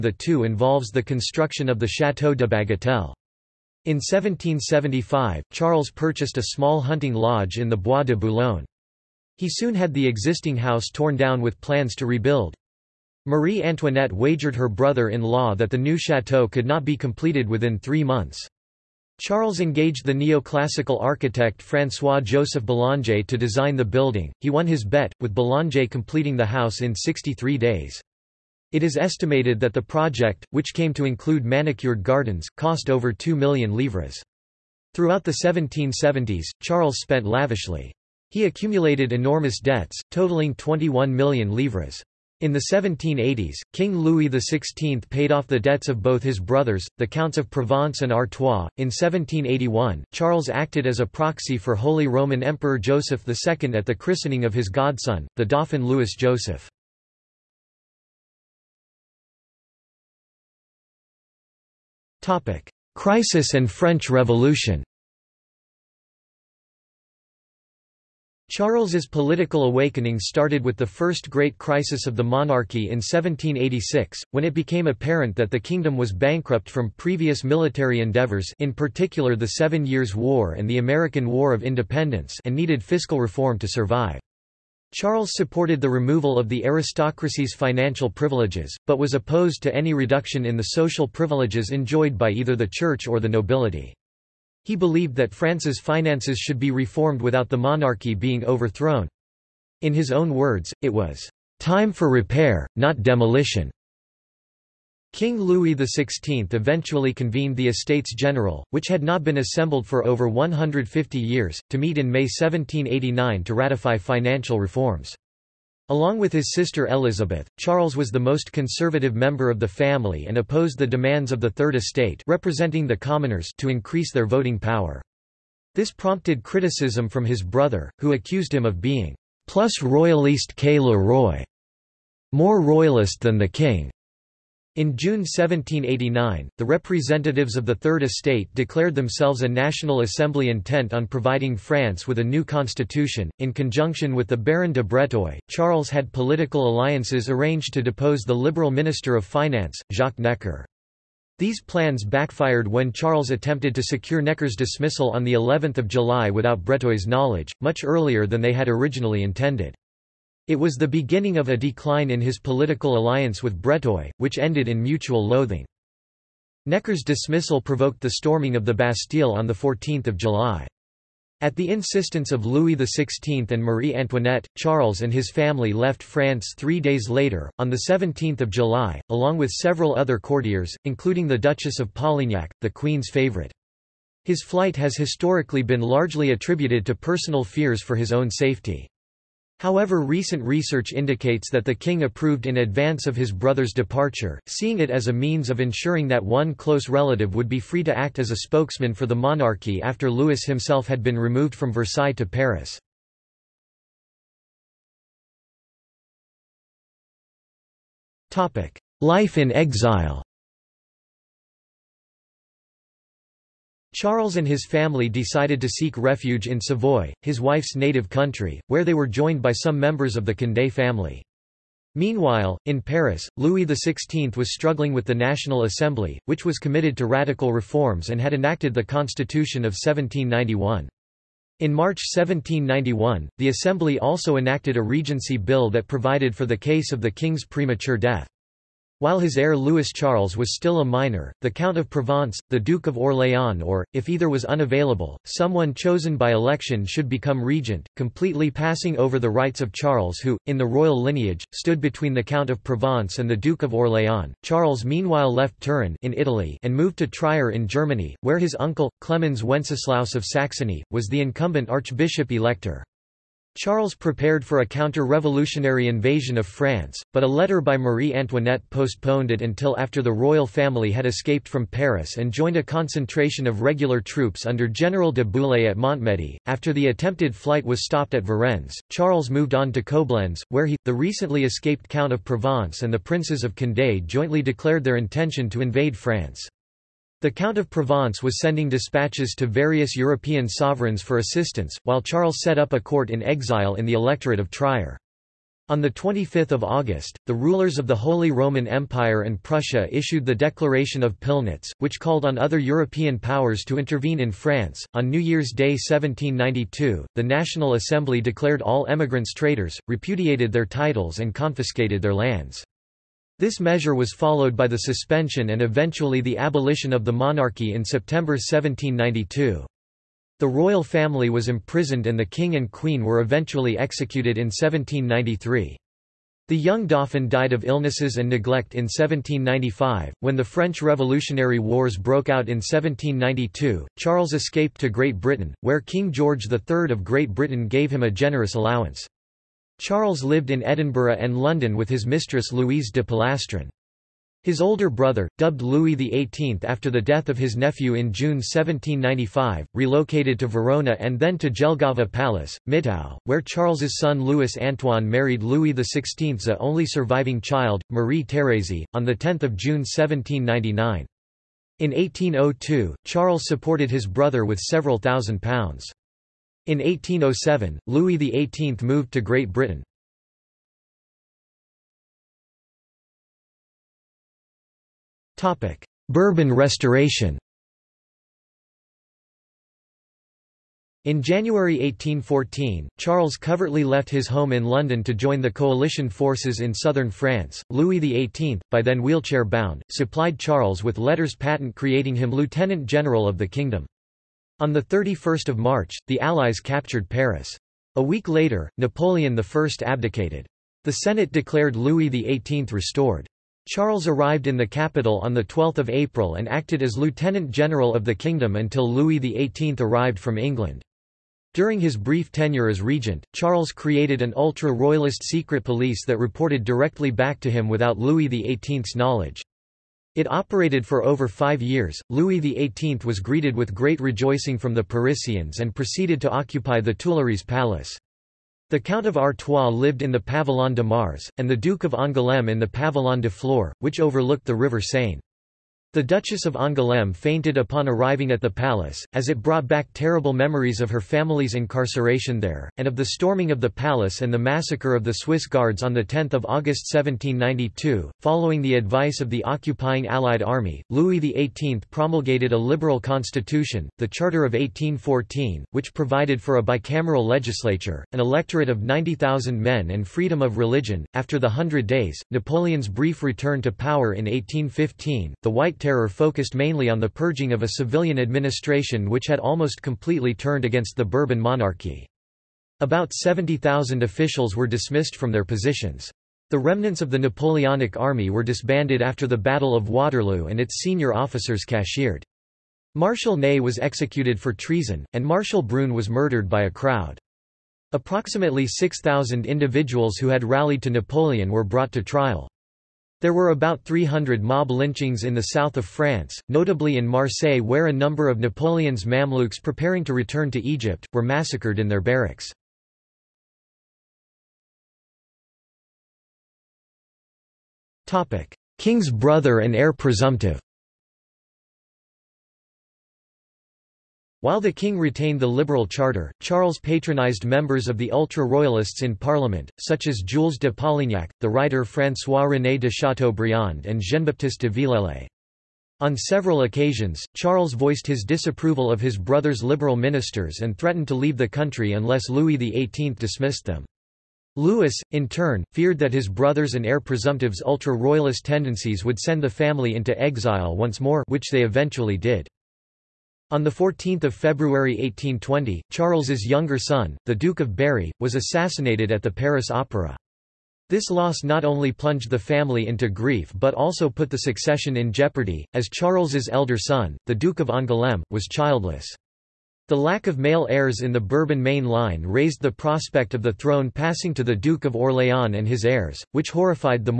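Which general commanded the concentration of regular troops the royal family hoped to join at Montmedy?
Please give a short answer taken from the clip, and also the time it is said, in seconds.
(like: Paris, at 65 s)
General de Bouillé, at 274 s.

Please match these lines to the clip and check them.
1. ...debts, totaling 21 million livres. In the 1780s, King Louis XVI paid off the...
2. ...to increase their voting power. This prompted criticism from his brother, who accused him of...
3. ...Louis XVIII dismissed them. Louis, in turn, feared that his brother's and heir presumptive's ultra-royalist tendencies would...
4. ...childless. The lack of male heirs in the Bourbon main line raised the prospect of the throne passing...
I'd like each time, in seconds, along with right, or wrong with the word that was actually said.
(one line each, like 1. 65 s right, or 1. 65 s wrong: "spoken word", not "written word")
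1. 39 s right
2. 123 s right
3. 532 s right
4. 558 s right.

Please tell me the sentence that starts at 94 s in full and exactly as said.
He believed that France's finances should be reformed without the monarchy being overthrown.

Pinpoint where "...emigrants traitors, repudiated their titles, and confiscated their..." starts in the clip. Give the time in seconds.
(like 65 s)
308 s.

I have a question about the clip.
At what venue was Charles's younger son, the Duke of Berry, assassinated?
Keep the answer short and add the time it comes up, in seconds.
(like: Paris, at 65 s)
Paris Opera, at 549 s.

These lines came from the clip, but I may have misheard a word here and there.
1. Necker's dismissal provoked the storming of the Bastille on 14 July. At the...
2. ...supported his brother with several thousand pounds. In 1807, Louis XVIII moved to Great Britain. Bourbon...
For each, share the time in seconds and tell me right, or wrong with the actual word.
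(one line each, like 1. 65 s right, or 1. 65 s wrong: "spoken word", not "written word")
1. 166 s right
2. 363 s right.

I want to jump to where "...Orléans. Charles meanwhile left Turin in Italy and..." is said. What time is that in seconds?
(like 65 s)
253 s.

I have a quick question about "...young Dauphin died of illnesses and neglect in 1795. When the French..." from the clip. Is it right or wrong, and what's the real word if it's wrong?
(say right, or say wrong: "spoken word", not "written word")
right.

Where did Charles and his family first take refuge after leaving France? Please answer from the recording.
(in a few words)
Savoy.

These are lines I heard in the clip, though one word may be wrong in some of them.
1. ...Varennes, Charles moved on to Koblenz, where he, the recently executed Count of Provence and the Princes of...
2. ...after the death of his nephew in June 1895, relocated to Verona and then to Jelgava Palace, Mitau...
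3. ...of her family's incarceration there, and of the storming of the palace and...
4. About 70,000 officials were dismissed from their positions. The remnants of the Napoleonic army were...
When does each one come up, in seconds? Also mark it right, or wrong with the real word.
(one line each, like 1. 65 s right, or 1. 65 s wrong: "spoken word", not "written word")
1. 278 s wrong: "escaped", not "executed"
2. 346 s wrong: "1795", not "1895"
3. 440 s right
4. 472 s right.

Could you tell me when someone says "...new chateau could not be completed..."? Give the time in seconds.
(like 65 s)
15 s.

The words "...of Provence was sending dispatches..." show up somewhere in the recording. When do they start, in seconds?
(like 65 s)
287 s.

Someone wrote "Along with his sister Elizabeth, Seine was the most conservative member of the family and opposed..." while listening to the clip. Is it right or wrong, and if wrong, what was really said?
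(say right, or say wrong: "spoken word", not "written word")
wrong: "Charles", not "Seine".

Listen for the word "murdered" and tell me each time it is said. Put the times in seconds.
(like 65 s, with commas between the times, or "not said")
486 s.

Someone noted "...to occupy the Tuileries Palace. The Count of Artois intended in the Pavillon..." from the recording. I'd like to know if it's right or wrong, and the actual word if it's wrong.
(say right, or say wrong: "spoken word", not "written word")
wrong: "lived", not "intended".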